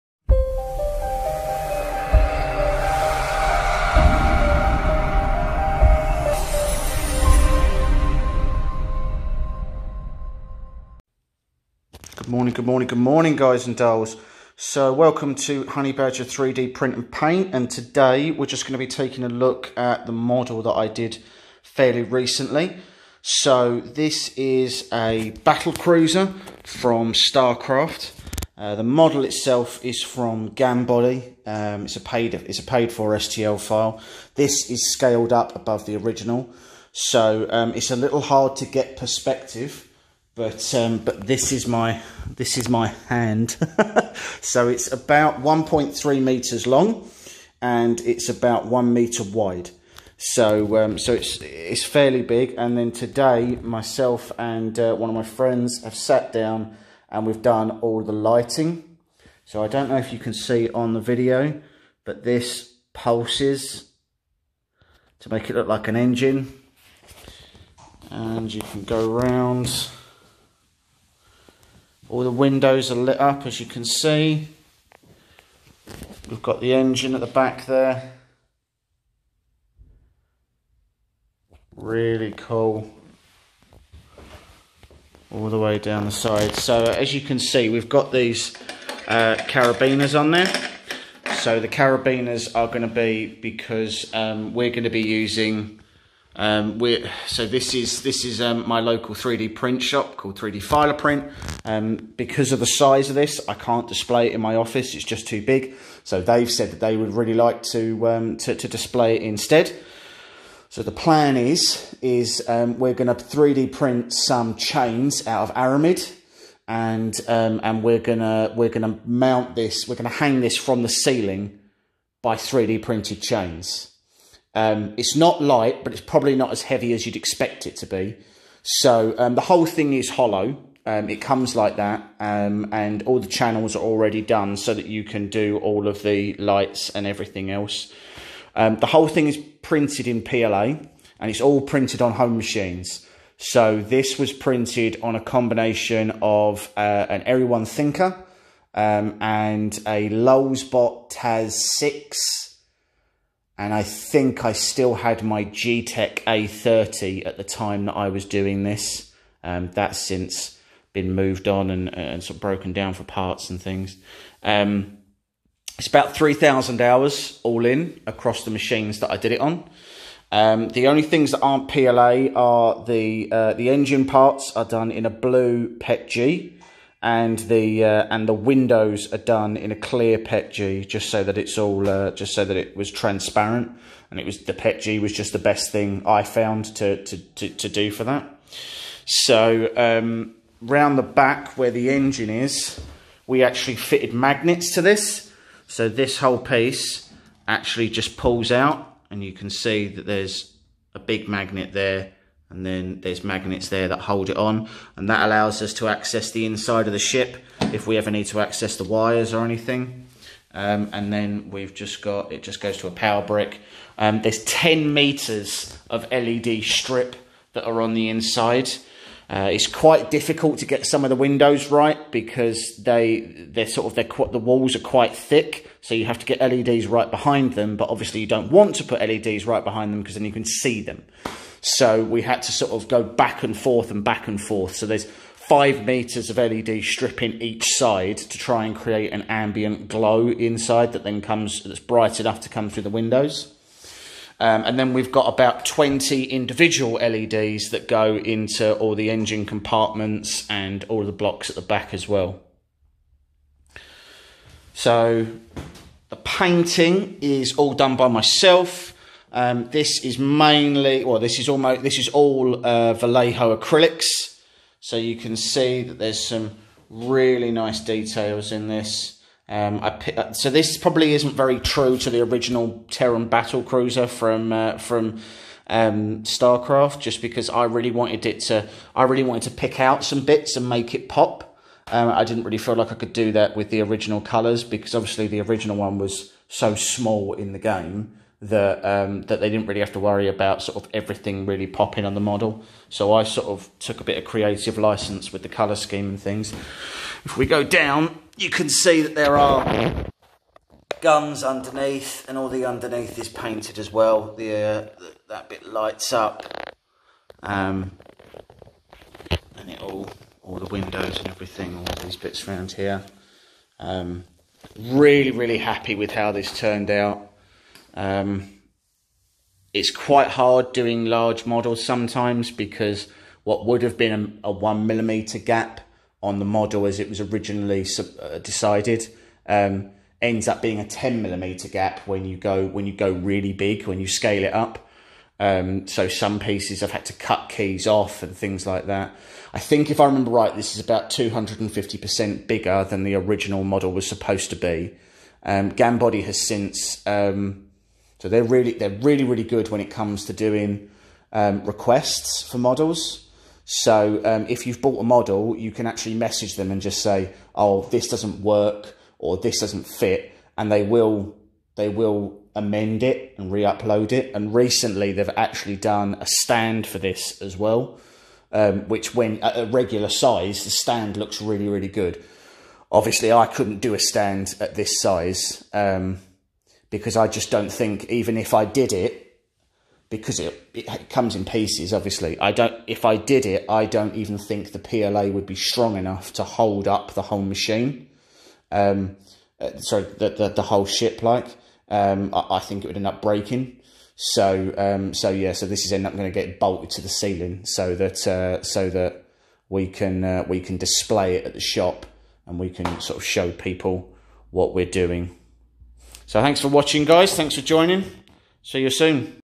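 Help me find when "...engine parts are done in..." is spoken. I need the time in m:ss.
2:53.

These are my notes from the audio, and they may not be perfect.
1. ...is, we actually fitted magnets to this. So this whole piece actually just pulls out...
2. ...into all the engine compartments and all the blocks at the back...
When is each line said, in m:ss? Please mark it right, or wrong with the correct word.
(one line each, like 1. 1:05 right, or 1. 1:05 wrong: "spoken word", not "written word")
1. 3:12 right
2. 4:08 right.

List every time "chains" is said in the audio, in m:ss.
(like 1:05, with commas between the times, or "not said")
1:54, 2:03.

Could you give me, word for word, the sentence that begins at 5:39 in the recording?
I think if I remember right, this is about 250% bigger than the original model was supposed to be.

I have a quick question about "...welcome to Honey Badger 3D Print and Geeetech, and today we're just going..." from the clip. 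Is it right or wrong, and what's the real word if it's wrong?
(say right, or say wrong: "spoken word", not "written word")
wrong: "Paint", not "Geeetech".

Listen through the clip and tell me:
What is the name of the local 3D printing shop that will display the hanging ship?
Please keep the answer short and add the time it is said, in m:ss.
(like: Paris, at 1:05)
3D Filer Print, at 1:40.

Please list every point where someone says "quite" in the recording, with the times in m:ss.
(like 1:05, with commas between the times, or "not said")
3:39, 3:44, 5:19.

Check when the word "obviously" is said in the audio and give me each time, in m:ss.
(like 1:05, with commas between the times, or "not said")
3:47, 4:44, 6:12, 6:21.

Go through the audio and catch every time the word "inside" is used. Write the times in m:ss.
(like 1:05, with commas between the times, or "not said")
3:26, 3:38, 4:00.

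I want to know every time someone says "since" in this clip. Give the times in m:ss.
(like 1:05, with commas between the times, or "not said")
2:39, 5:46.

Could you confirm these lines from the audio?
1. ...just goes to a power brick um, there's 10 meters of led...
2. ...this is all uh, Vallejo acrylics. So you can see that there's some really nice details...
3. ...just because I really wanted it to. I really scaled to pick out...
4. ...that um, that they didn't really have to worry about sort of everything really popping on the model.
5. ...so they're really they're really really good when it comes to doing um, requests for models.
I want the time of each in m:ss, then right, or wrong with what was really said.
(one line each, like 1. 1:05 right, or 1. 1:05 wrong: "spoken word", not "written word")
1. 3:32 right
2. 4:21 right
3. 4:36 wrong: "wanted", not "scaled"
4. 4:48 right
5. 5:48 right.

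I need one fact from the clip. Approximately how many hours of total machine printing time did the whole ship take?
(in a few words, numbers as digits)
3,000 hours.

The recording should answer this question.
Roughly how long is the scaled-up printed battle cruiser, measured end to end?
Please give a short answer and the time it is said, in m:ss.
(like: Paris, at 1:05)
1.3 meters, at 0:45.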